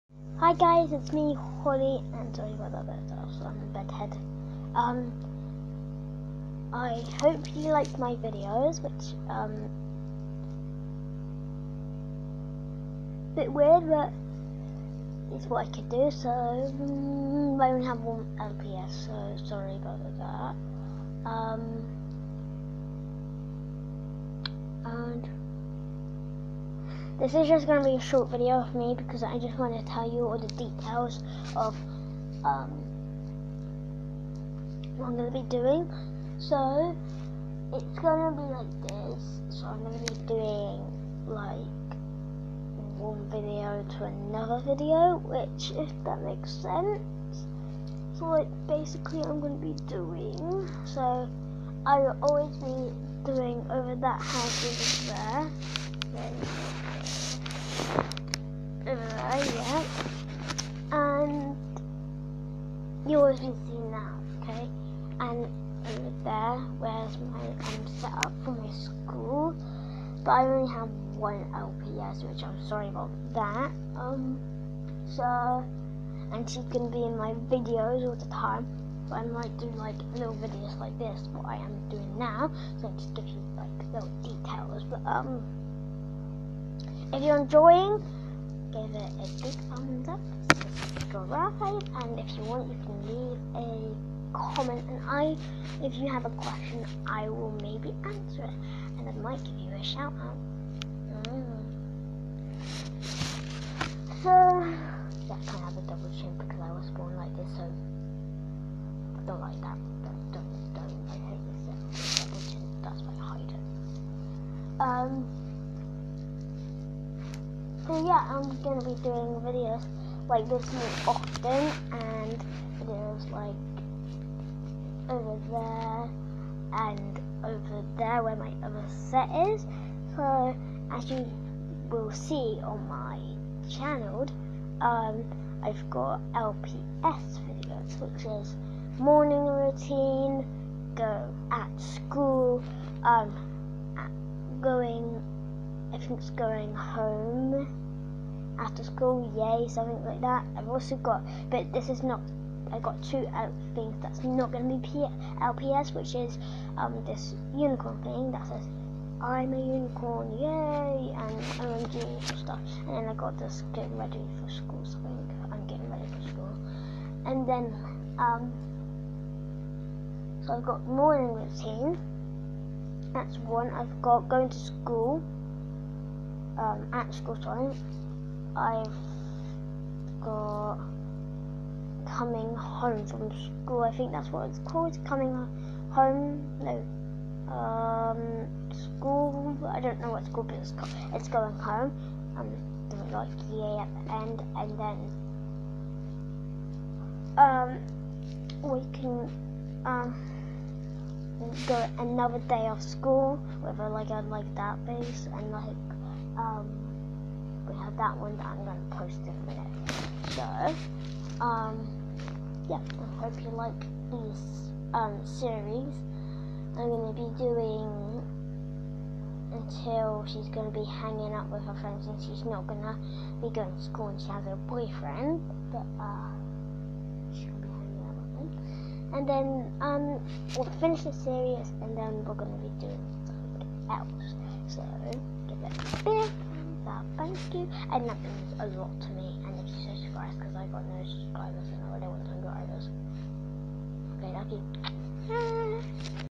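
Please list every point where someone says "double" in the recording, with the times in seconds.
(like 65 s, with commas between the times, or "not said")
105 s, 112 s.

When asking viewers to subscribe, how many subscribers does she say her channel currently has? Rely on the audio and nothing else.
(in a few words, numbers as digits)
no subscribers.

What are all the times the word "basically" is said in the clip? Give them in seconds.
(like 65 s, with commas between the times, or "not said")
48 s.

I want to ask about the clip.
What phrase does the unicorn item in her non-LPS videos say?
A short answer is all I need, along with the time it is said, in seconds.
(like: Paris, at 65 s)
I'm a unicorn, at 159 s.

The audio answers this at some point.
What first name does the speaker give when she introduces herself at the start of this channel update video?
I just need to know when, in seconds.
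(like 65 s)
1 s.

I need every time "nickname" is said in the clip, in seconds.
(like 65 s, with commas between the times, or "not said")
not said.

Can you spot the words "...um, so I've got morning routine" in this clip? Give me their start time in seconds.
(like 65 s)
168 s.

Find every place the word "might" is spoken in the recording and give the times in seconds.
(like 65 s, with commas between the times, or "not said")
79 s, 99 s.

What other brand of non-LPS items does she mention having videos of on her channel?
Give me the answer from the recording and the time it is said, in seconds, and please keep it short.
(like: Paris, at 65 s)
OMG, at 161 s.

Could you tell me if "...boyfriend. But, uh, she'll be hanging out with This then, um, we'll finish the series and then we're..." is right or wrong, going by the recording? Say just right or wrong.
wrong.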